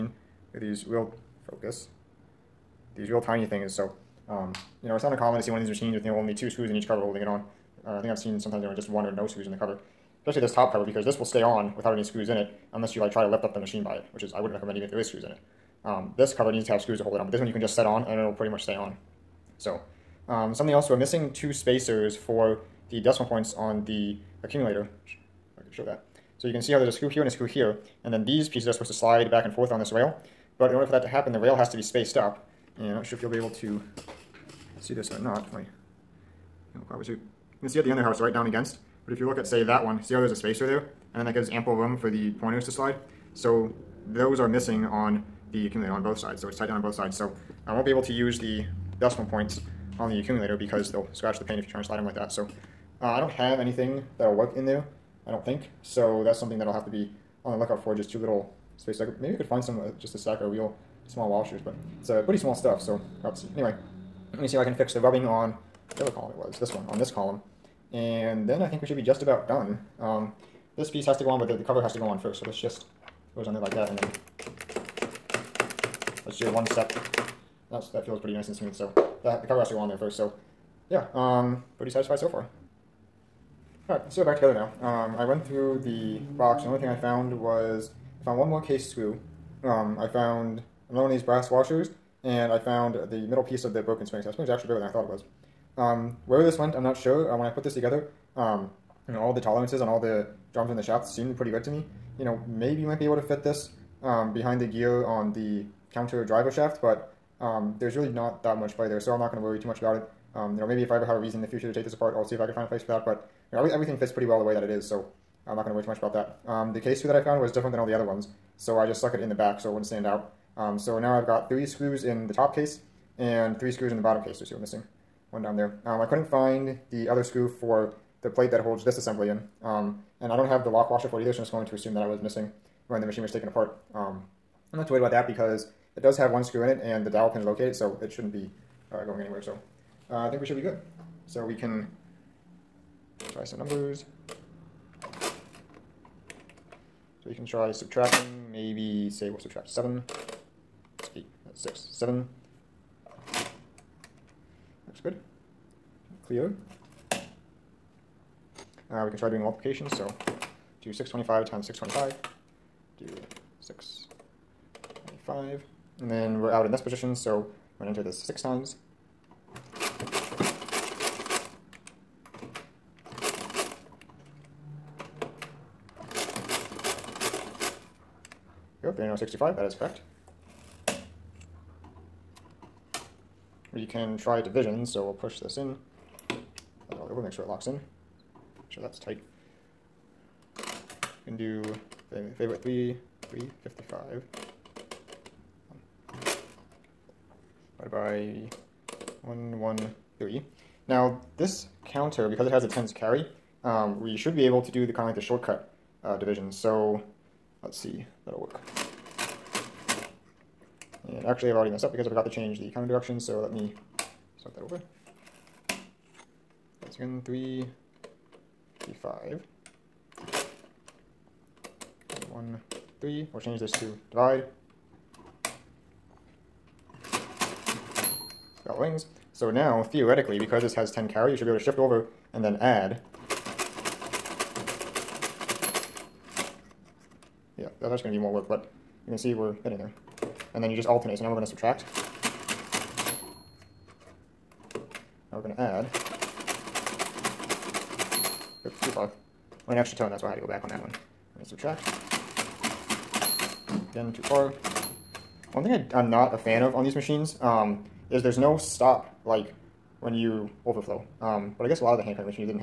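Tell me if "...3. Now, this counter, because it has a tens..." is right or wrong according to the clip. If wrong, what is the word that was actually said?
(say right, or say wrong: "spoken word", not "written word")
right.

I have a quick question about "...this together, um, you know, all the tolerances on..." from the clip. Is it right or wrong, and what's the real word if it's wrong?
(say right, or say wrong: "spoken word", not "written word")
right.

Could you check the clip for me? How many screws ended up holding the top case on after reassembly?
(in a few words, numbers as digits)
3.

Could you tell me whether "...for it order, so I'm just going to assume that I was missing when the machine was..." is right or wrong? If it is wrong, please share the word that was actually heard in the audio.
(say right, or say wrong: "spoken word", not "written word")
wrong: "either", not "order".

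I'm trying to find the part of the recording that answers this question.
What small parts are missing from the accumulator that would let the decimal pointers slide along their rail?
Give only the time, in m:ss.
0:21.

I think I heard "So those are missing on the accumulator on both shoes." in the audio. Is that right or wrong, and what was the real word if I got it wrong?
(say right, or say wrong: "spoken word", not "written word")
wrong: "sides", not "shoes".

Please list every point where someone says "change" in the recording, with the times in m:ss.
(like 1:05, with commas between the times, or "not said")
3:32, 3:43.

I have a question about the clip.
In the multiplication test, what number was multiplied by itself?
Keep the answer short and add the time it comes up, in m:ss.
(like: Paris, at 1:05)
625, at 2:40.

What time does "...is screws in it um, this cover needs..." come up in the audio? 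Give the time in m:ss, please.
0:14.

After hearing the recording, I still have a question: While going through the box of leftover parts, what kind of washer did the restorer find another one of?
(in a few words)
Brass washers.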